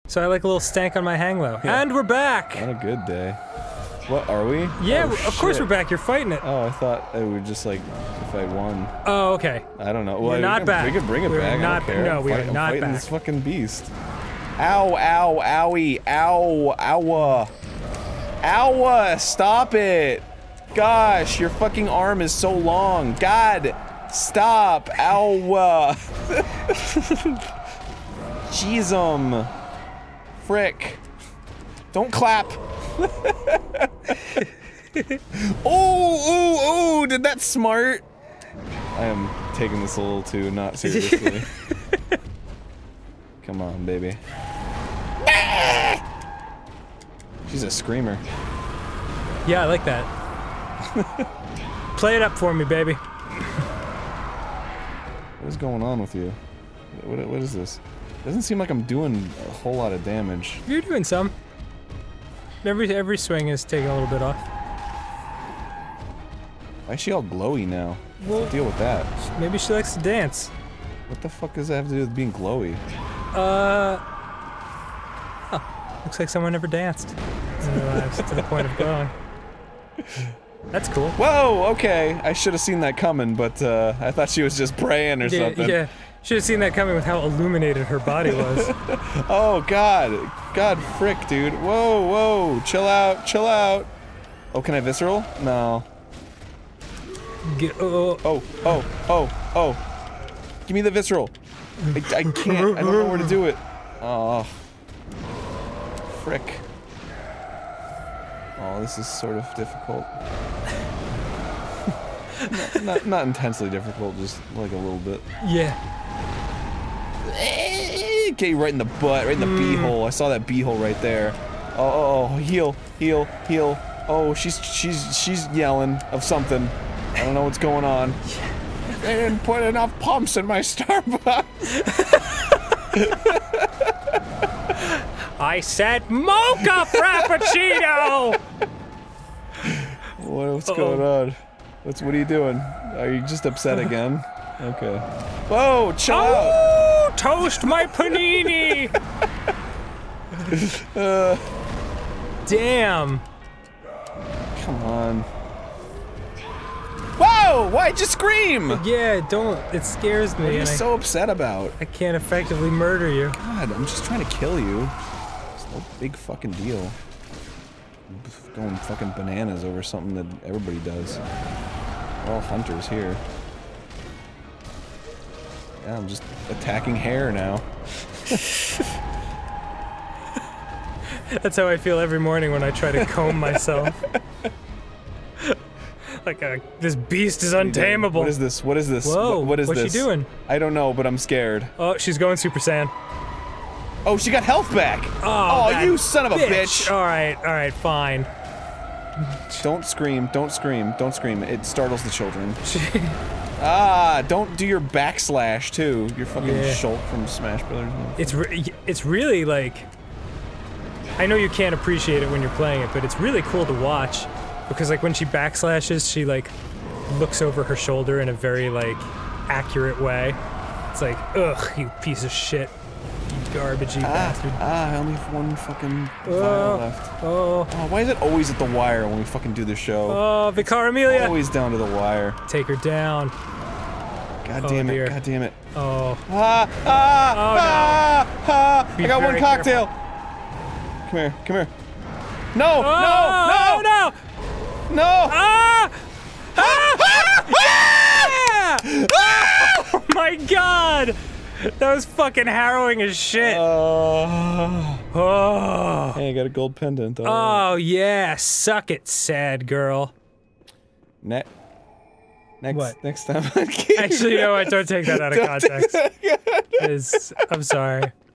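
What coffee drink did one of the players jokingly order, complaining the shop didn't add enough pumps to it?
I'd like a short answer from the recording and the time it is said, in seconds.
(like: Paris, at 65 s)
mocha frappuccino, at 136 s.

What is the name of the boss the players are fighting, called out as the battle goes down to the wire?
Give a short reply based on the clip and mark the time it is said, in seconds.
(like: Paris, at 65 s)
Vicar Amelia, at 230 s.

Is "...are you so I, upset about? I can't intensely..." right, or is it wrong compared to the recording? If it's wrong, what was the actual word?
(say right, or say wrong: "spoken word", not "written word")
wrong: "effectively", not "intensely".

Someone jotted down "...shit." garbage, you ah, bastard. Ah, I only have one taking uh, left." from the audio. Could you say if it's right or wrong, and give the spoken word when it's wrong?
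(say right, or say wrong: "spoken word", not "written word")
wrong: "fucking", not "taking".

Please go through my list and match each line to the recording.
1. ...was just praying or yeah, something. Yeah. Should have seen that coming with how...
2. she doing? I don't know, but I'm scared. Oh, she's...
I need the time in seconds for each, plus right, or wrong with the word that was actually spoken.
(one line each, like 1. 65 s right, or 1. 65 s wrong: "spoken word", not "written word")
1. 84 s right
2. 189 s right.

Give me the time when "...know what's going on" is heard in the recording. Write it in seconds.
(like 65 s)
127 s.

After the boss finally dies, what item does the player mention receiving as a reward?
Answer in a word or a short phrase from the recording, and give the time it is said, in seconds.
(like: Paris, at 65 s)
gold pendant, at 256 s.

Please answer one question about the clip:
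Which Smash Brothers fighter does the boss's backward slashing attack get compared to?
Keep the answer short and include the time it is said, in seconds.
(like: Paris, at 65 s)
Shulk, at 206 s.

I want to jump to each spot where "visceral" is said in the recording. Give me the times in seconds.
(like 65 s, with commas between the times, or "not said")
94 s, 100 s.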